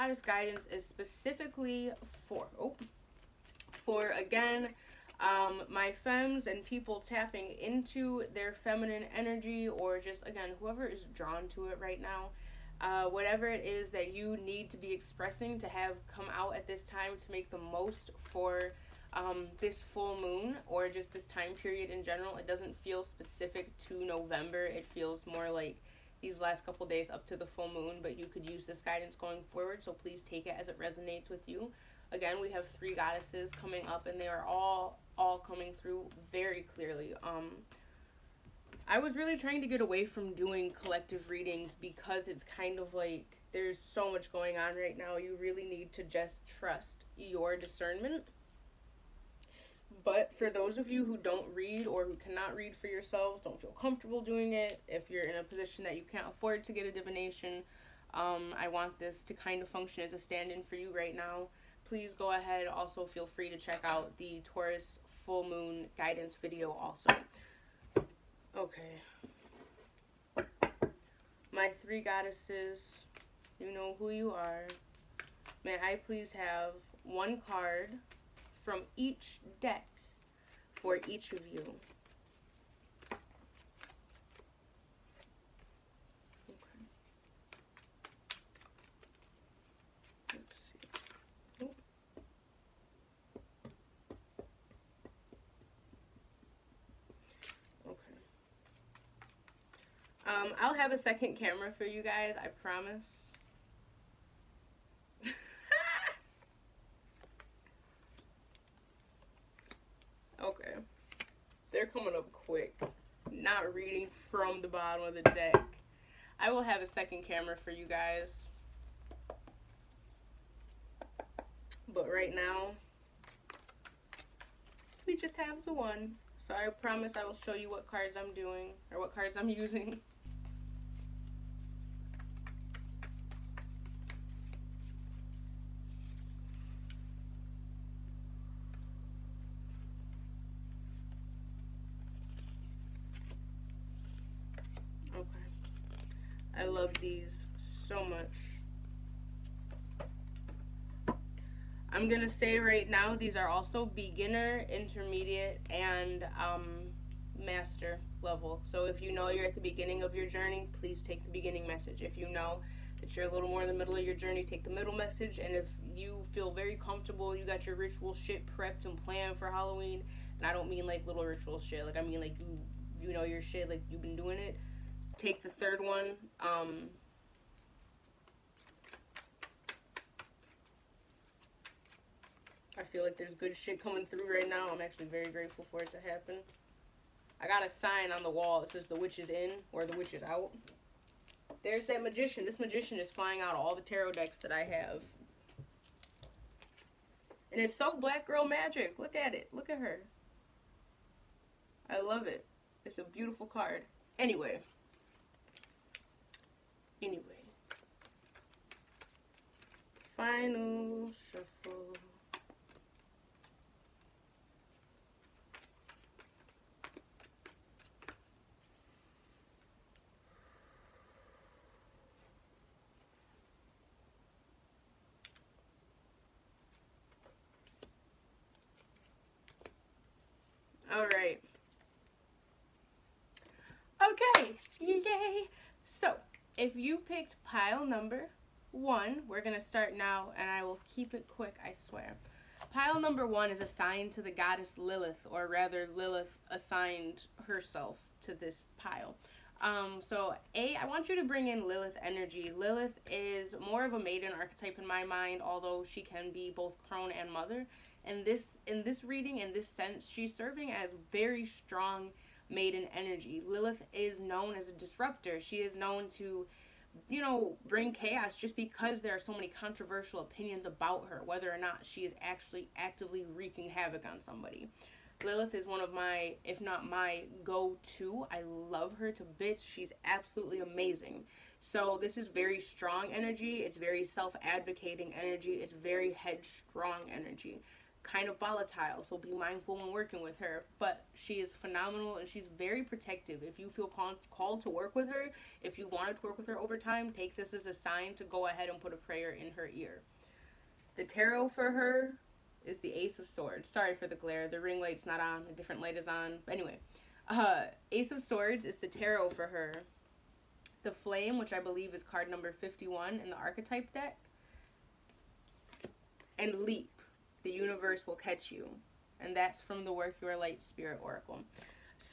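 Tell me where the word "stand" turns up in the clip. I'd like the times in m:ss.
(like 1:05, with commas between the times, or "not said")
1:00.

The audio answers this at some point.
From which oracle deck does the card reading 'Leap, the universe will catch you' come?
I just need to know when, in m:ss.
5:19.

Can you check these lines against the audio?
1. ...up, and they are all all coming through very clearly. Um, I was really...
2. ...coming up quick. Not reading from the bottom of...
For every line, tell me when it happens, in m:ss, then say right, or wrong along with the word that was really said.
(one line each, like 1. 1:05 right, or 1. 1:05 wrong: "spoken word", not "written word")
1. 0:33 right
2. 1:51 right.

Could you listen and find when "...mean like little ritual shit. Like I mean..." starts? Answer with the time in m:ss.
2:50.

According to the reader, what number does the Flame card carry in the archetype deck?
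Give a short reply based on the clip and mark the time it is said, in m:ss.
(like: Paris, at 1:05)
51, at 5:12.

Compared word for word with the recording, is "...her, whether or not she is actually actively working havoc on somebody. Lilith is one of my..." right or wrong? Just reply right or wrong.
wrong.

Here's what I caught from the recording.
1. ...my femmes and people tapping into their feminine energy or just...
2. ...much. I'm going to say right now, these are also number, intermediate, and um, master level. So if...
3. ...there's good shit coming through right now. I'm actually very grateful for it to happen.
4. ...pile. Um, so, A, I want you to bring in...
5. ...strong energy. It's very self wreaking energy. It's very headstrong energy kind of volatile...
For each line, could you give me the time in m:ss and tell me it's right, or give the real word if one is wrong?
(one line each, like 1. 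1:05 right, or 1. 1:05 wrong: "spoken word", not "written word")
1. 0:05 right
2. 2:28 wrong: "beginner", not "number"
3. 3:03 right
4. 4:08 right
5. 4:42 wrong: "advocating", not "wreaking".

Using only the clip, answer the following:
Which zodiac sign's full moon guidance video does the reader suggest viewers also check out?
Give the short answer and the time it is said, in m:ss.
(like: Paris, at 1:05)
Taurus, at 1:04.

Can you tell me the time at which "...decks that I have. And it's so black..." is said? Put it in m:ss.
3:14.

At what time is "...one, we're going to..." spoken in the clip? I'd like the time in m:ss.
3:58.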